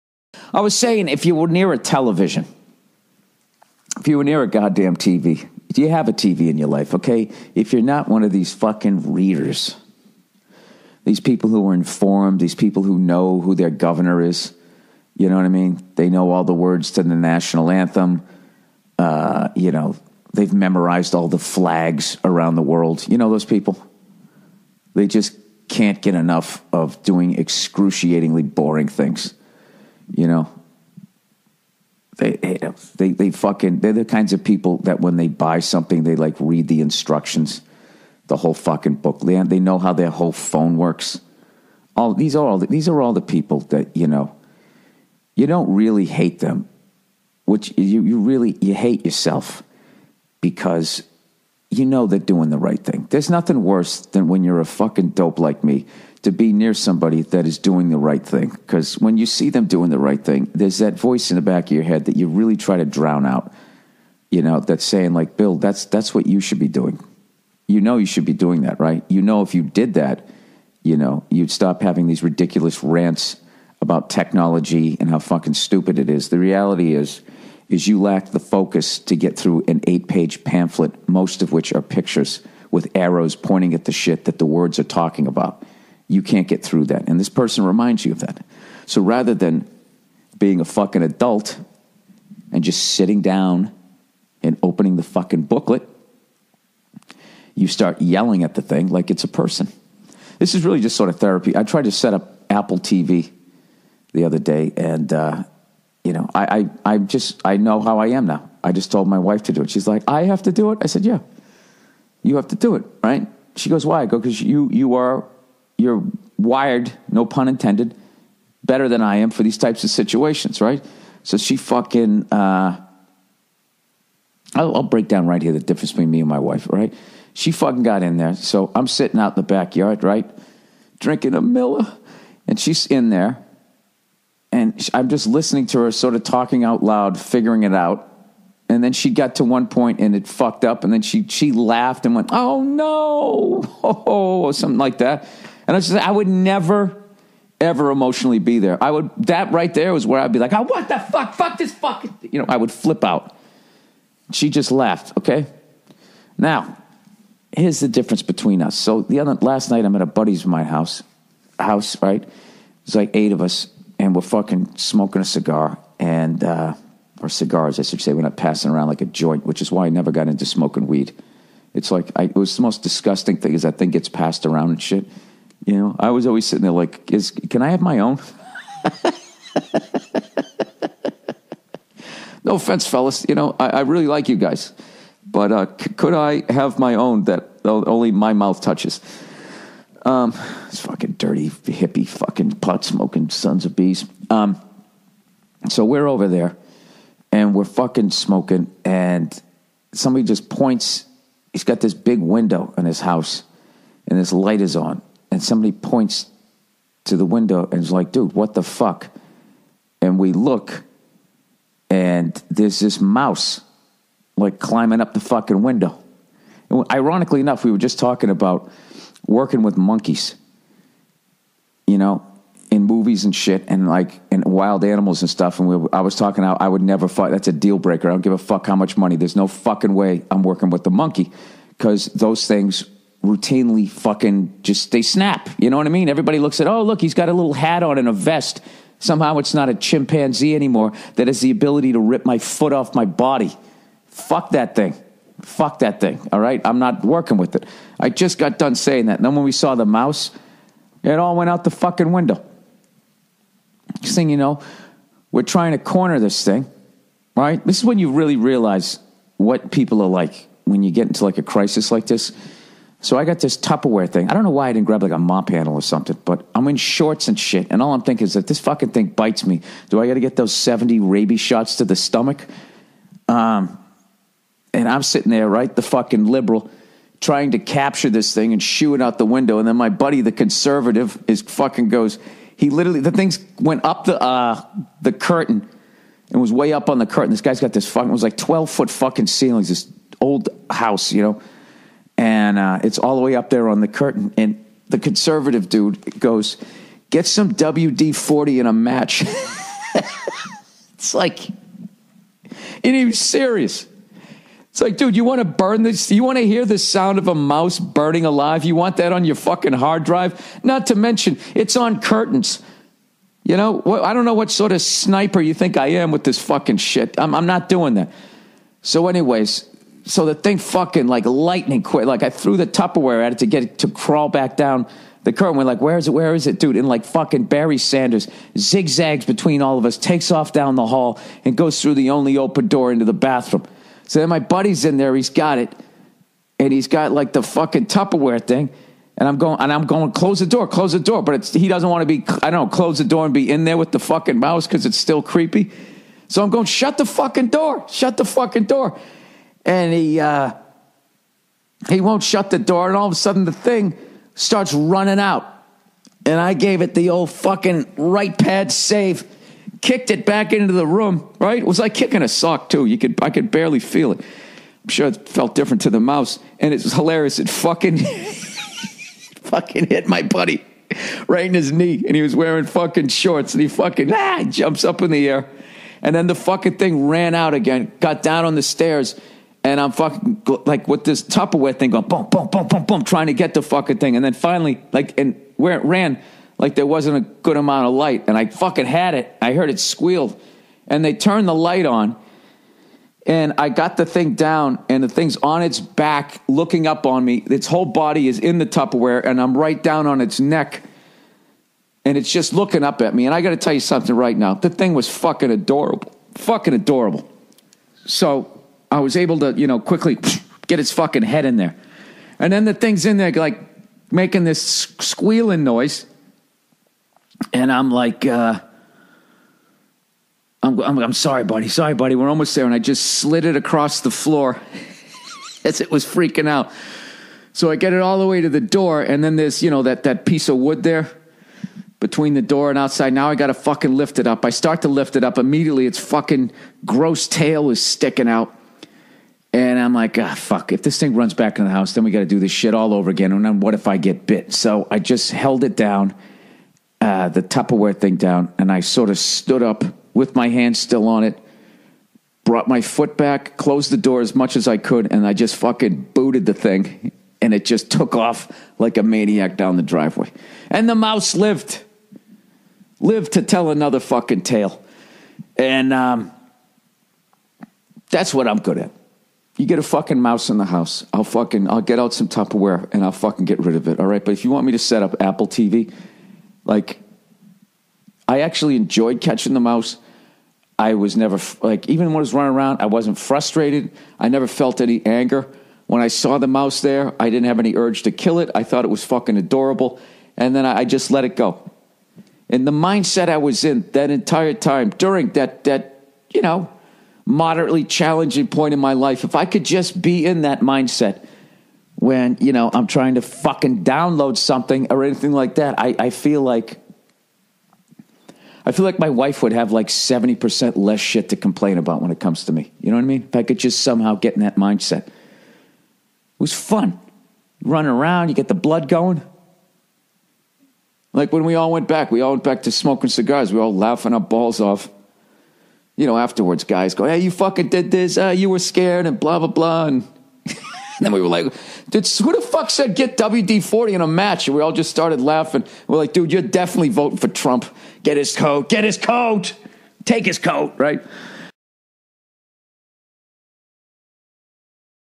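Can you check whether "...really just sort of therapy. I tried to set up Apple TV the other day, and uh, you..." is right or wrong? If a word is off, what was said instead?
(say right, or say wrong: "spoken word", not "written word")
right.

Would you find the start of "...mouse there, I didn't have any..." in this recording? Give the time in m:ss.
8:06.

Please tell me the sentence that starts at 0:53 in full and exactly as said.
There's nothing worse than when you're a fucking dope like me to be near somebody that is doing the right thing.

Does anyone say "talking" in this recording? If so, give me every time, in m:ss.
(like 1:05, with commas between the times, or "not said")
1:24, 2:16, 3:37, 3:46.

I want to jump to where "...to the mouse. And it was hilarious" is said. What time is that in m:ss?
6:05.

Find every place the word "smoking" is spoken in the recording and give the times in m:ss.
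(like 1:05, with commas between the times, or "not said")
2:44, 2:50, 3:12, 3:18, 8:42.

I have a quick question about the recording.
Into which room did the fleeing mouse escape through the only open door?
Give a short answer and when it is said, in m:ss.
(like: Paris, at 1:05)
Bathroom, at 5:33.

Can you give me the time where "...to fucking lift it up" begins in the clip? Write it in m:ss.
7:13.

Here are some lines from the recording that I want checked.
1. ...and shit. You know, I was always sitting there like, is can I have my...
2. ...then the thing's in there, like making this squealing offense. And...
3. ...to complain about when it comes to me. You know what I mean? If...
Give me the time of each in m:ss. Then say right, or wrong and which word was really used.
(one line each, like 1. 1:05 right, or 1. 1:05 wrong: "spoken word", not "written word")
1. 2:54 right
2. 6:52 wrong: "noise", not "offense"
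3. 8:31 right.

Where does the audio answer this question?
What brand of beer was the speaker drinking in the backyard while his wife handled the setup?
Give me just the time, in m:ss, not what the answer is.
2:11.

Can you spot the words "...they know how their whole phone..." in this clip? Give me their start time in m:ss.
0:39.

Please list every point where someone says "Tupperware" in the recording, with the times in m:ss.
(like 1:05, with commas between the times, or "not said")
4:23, 5:22, 5:37, 6:21, 6:38, 7:27, 7:52.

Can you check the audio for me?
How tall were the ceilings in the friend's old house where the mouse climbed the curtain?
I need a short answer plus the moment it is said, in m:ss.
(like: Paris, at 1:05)
12 feet, at 4:48.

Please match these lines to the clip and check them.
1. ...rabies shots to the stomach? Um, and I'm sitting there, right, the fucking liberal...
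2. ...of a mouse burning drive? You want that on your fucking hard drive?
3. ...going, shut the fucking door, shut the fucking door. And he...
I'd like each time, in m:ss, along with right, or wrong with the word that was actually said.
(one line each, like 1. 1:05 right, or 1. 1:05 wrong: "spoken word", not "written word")
1. 4:30 right
2. 5:07 wrong: "alive", not "drive"
3. 5:46 right.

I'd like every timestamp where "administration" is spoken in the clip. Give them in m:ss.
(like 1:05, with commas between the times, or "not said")
not said.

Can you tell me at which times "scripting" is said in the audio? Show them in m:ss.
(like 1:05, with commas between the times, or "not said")
not said.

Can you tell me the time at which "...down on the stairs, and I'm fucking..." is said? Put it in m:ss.
6:18.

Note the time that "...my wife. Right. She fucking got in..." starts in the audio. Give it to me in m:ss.
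2:06.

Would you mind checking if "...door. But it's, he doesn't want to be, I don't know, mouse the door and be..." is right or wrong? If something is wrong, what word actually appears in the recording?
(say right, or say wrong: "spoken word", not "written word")
wrong: "close", not "mouse".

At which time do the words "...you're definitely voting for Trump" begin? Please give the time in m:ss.
8:56.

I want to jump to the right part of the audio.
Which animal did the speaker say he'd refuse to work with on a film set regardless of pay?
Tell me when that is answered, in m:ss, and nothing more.
3:50.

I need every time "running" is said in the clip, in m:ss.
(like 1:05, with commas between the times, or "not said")
5:54, 8:02, 8:37.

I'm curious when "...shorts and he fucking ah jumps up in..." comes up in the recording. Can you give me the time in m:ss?
6:13.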